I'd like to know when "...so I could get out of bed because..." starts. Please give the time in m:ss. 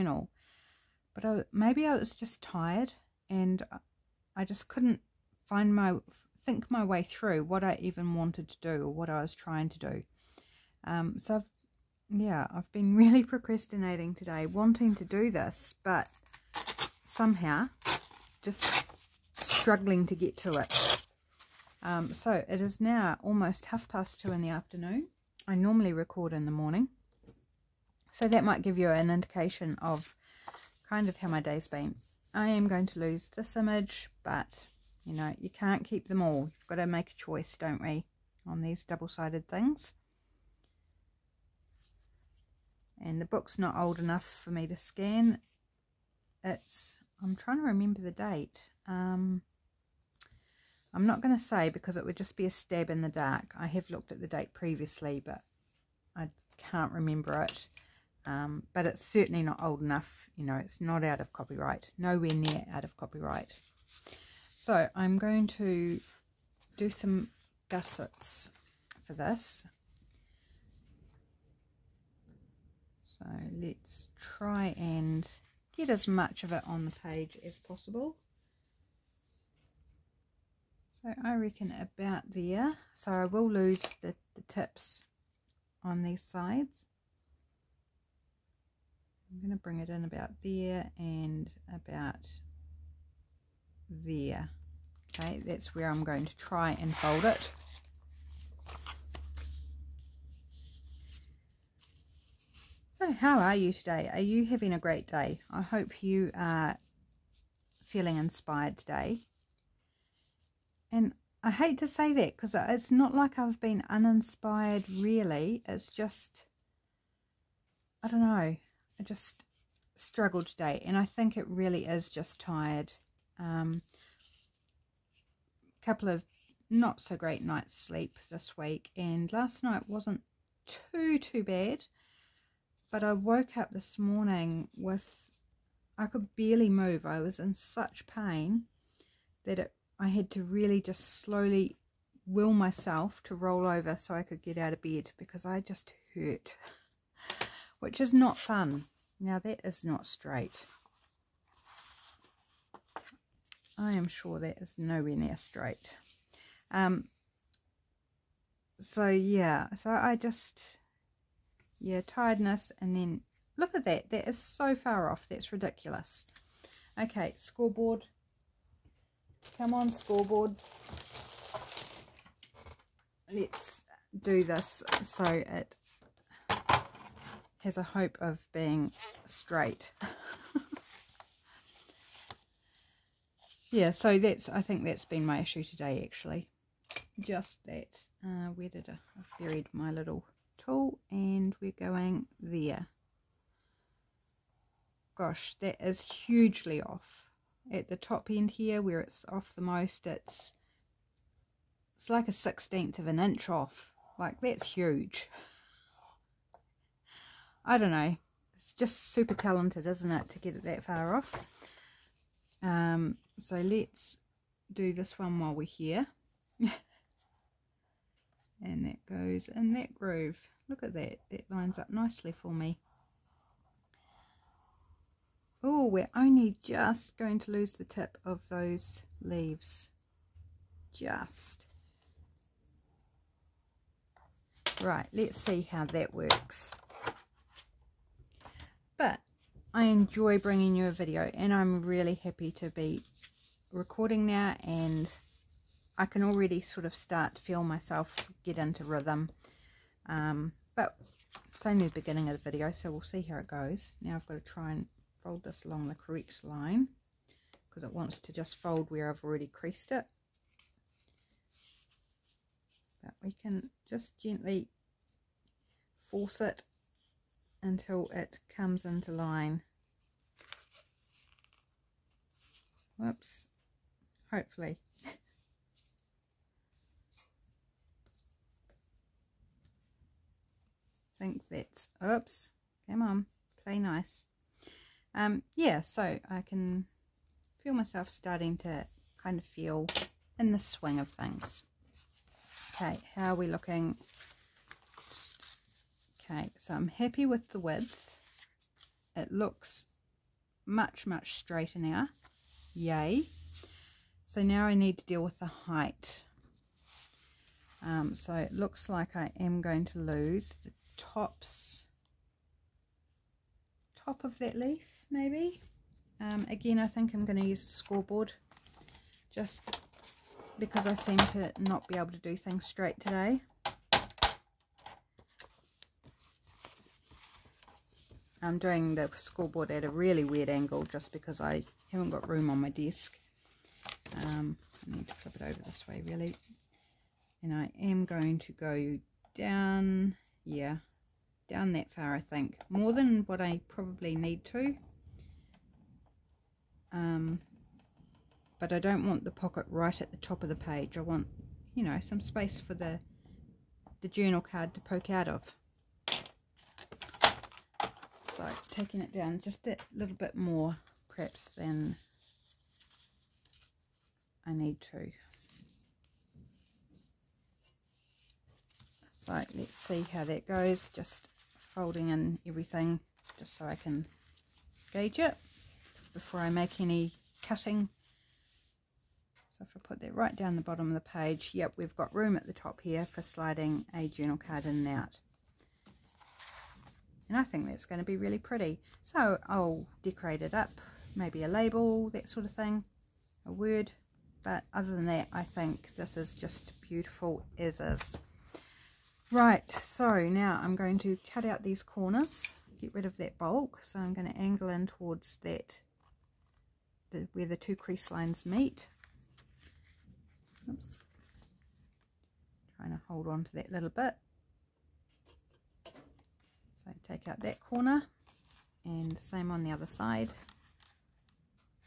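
2:23.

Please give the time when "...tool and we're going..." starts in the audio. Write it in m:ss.
3:10.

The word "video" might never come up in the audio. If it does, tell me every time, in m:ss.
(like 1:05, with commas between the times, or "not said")
4:00, 4:12.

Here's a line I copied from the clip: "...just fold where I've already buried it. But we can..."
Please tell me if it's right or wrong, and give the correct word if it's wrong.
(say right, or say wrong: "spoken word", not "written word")
wrong: "creased", not "buried".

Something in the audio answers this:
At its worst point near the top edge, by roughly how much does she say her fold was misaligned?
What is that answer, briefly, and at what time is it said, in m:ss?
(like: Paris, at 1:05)
a sixteenth of an inch, at 3:22.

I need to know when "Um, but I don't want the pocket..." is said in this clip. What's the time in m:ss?
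5:46.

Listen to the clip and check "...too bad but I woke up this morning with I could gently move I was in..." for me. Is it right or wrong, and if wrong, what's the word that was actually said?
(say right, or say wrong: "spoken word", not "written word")
wrong: "barely", not "gently".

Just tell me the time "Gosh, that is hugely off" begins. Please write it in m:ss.
3:15.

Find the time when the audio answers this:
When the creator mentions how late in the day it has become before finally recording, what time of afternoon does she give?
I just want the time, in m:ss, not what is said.
0:23.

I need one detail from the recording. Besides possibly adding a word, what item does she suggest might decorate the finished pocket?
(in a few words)
a label.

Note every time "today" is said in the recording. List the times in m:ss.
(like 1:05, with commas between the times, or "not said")
0:14, 1:43, 1:48, 2:00, 3:05, 5:23.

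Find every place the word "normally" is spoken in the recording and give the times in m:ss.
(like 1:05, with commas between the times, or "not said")
0:25.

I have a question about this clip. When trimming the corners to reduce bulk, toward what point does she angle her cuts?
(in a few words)
where the two crease lines meet.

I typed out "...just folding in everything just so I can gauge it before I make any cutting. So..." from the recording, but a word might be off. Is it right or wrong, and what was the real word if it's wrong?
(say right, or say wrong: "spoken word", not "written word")
right.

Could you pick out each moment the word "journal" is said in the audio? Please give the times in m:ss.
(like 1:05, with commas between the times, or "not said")
5:54, 6:24.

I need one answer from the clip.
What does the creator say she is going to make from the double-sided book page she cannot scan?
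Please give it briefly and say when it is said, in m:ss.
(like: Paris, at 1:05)
gussets, at 1:07.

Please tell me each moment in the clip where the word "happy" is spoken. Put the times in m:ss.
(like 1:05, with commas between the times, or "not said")
4:02, 4:56.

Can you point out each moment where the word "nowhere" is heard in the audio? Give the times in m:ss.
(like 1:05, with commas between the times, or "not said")
1:01, 2:34.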